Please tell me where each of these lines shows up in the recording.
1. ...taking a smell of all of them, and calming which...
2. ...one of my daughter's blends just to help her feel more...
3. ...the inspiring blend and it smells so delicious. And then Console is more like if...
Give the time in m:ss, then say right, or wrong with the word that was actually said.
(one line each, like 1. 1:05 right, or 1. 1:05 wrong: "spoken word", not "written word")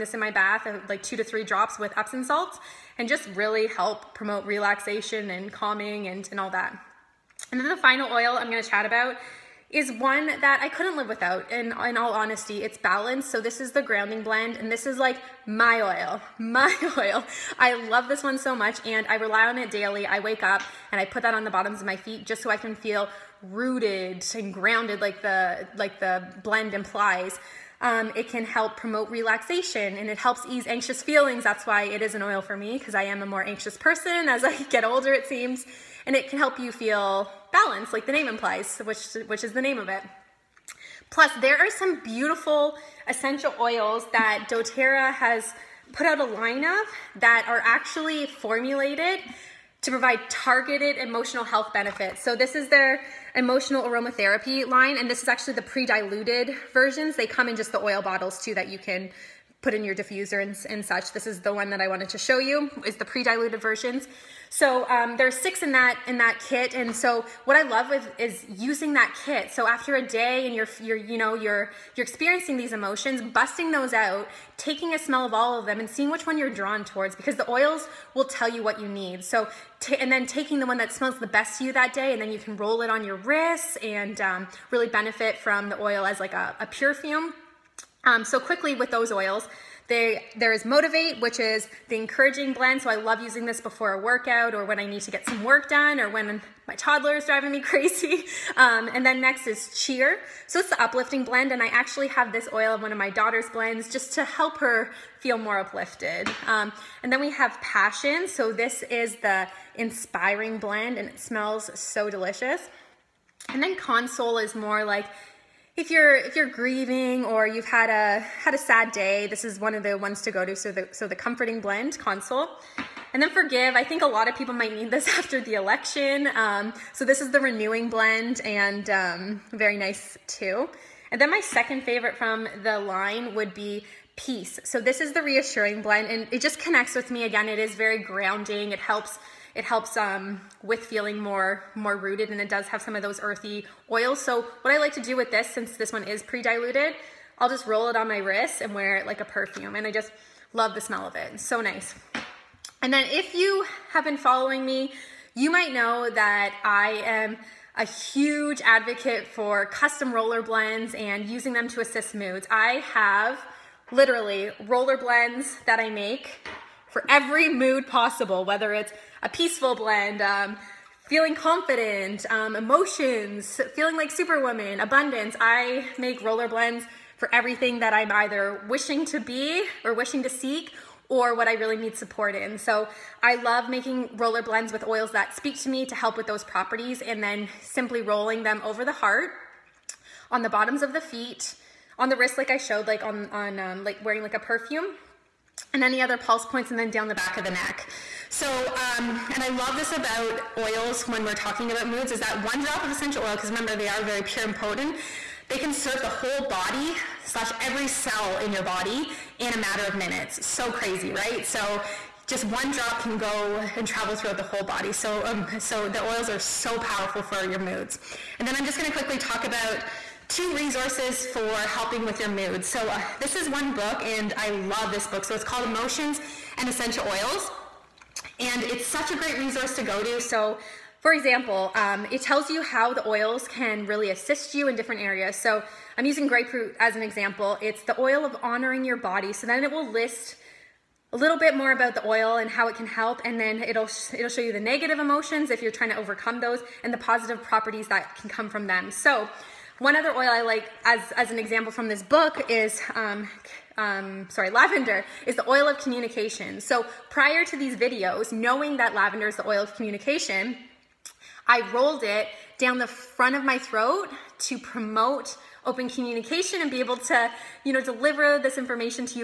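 1. 1:14 wrong: "seeing", not "calming"
2. 1:42 right
3. 1:49 right.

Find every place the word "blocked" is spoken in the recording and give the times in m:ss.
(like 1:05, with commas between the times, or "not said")
not said.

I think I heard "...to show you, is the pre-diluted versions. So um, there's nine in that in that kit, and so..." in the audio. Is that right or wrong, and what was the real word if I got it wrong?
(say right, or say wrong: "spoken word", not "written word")
wrong: "six", not "nine".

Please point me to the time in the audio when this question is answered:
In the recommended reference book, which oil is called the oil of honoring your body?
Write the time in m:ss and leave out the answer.
3:56.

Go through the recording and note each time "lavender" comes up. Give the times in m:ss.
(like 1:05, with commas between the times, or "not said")
4:14, 4:18.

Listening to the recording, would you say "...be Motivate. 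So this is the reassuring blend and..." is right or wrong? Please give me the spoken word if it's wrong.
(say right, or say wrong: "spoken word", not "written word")
wrong: "Peace", not "Motivate".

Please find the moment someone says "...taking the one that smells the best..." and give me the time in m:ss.
1:20.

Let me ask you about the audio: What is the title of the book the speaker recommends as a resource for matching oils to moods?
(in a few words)
Emotions and Essential Oils.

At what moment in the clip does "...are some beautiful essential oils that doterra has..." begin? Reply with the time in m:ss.
0:41.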